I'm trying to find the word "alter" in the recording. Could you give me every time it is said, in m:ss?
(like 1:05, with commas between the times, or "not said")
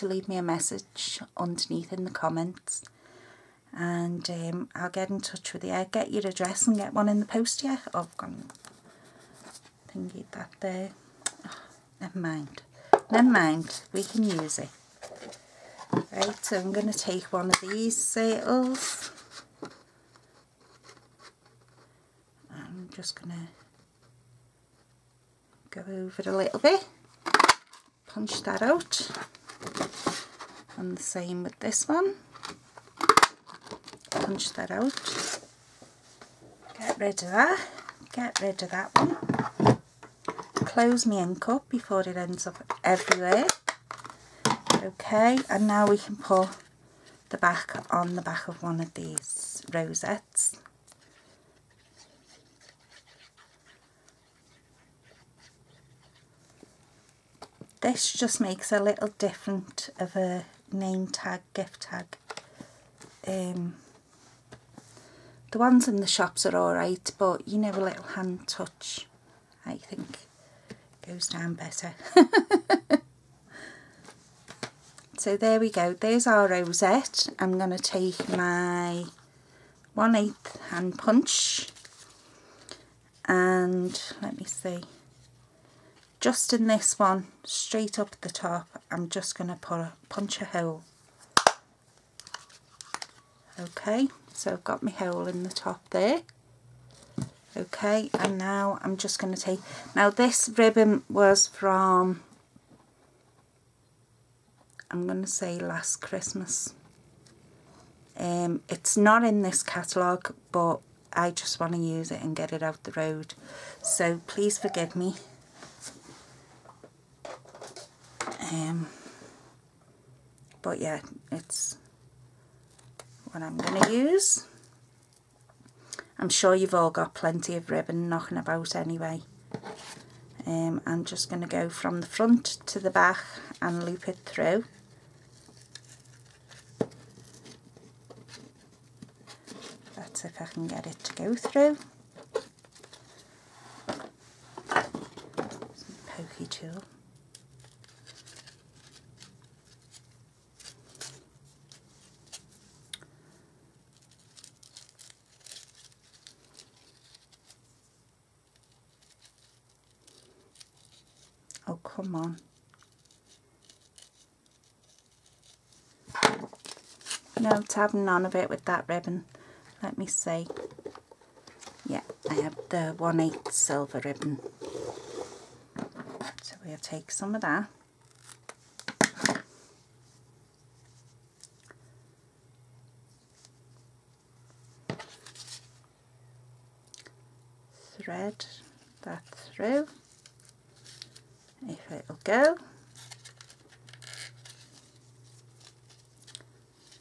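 not said.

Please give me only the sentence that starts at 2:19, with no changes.
That's if I can get it to go through.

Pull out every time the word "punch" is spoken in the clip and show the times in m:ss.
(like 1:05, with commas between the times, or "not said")
0:28, 0:34, 1:20, 1:30.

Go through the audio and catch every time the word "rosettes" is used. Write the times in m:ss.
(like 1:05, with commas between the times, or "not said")
0:49, 1:16.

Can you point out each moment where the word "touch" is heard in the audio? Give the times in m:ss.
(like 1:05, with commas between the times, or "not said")
0:05, 1:08.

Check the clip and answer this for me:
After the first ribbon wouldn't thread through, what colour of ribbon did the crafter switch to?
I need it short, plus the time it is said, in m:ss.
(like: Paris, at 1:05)
silver, at 2:53.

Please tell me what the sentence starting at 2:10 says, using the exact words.
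Um, I'm just going to go from the front to the back and loop it through.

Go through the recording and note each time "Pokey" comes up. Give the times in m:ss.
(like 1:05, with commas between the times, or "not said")
2:26.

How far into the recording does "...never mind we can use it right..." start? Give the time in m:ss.
0:13.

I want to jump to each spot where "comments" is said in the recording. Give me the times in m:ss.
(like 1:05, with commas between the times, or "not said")
0:02.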